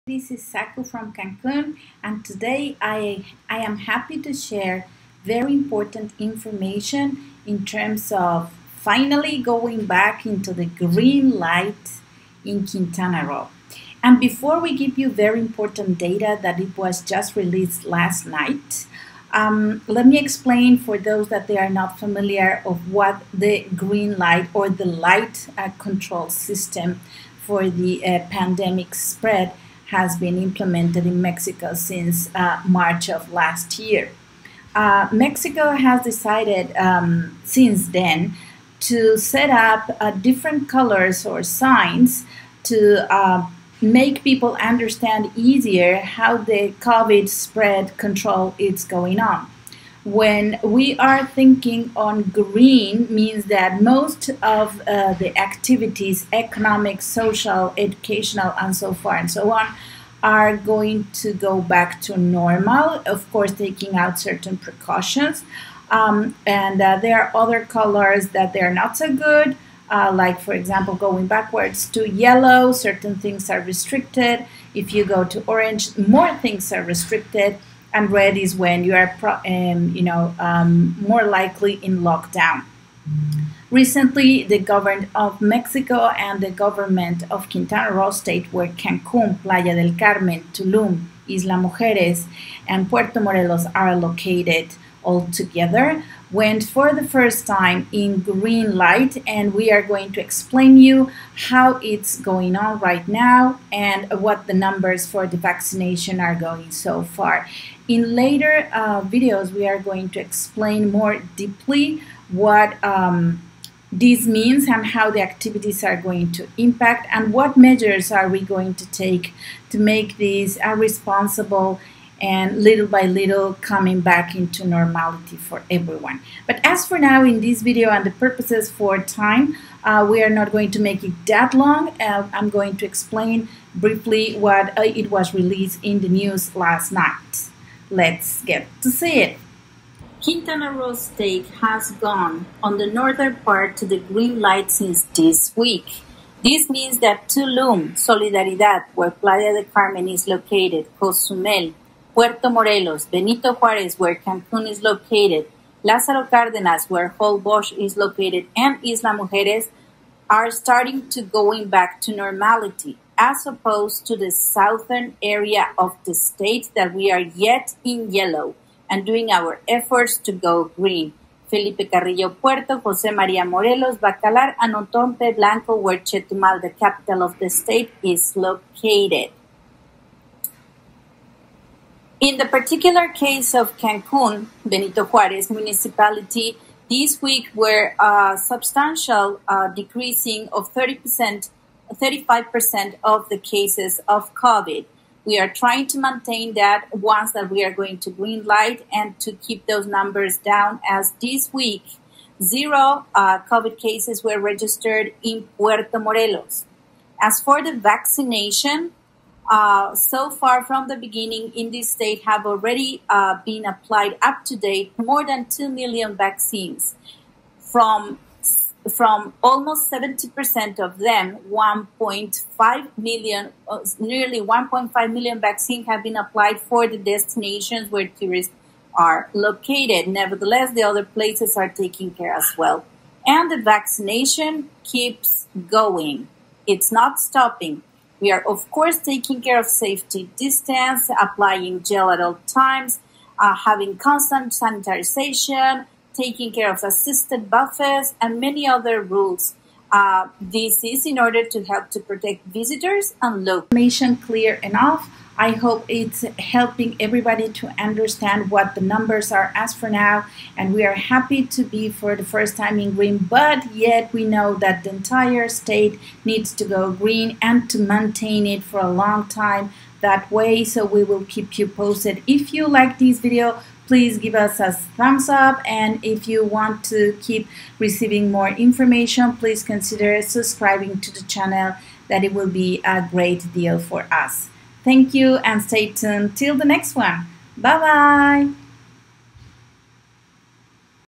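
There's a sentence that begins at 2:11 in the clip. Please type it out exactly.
Uh, I'm going to explain briefly what uh, it was released in the news last night.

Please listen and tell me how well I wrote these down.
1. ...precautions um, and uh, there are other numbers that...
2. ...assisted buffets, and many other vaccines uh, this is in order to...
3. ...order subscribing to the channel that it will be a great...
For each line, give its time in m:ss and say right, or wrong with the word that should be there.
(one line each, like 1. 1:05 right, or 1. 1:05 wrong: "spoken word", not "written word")
1. 1:04 wrong: "colors", not "numbers"
2. 4:06 wrong: "rules", not "vaccines"
3. 4:39 wrong: "consider", not "order".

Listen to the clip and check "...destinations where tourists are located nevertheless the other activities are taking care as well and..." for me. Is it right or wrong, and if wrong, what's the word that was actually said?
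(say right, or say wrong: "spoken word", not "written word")
wrong: "places", not "activities".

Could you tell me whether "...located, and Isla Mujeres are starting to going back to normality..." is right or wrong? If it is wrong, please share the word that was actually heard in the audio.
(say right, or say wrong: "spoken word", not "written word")
right.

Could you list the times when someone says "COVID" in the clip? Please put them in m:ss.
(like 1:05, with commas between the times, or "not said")
0:46, 3:14, 3:23.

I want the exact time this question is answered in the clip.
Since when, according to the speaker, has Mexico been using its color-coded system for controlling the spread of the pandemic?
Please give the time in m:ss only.
0:32.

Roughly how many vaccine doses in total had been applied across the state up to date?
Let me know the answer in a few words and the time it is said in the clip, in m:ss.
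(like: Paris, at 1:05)
more than 2 million, at 3:34.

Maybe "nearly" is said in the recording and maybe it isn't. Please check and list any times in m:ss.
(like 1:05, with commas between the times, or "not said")
3:43.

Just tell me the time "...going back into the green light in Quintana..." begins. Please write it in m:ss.
0:09.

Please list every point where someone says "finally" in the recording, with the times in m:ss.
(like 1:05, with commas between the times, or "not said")
0:08.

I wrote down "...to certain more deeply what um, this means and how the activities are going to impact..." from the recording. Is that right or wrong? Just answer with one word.
wrong.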